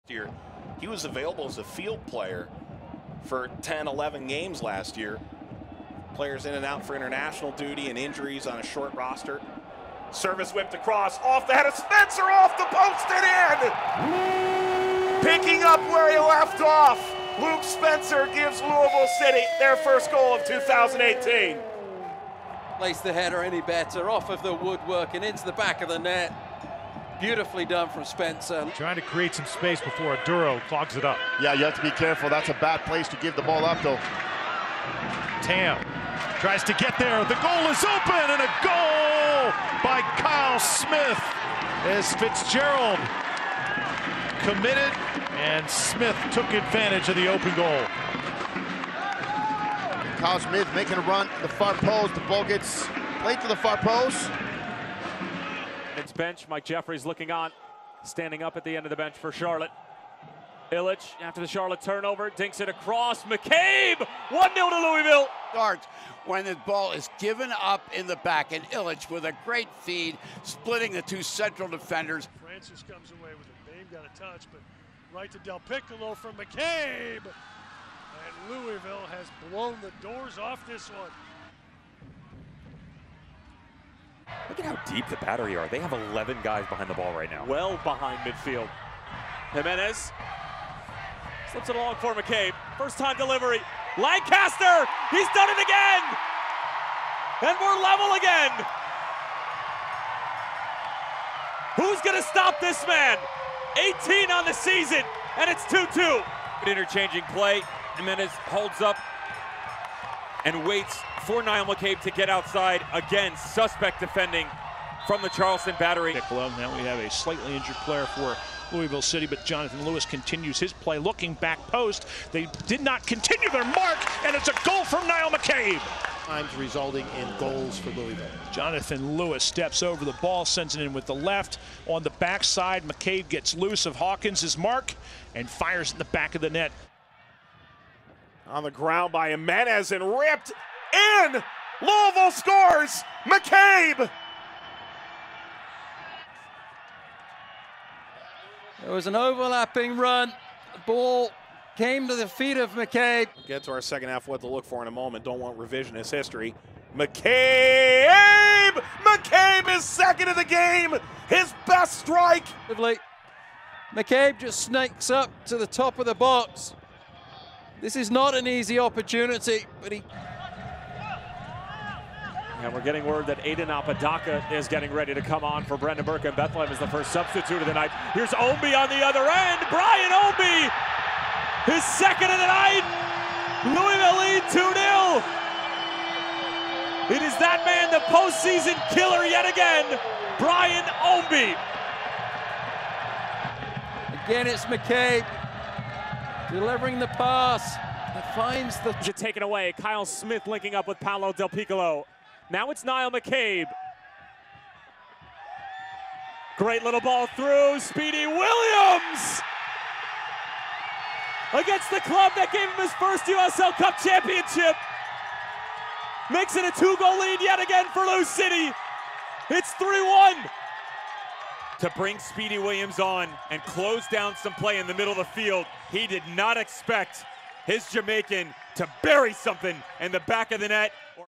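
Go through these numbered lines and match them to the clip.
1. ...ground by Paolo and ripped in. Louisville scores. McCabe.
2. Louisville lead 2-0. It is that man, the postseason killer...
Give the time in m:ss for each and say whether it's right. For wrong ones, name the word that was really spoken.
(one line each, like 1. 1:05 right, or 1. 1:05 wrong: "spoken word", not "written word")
1. 2:18 wrong: "Jimenez", not "Paolo"
2. 3:03 right.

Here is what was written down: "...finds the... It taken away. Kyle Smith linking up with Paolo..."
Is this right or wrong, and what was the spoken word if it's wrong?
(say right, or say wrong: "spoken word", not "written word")
right.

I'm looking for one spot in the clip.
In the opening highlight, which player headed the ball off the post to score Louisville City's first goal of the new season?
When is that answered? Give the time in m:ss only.
0:17.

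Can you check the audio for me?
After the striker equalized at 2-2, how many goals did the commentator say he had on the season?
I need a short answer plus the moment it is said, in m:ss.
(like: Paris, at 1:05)
18, at 1:44.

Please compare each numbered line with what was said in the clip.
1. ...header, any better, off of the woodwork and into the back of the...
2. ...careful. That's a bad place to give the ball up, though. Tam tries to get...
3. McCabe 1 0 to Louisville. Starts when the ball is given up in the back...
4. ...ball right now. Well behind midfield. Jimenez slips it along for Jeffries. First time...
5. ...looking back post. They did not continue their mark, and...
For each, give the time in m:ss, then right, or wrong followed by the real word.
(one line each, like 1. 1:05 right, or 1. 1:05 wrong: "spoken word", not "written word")
1. 0:23 right
2. 0:31 right
3. 1:03 right
4. 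1:26 wrong: "McCabe", not "Jeffries"
5. 2:00 right.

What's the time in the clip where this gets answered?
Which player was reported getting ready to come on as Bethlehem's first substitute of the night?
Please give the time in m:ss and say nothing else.
2:53.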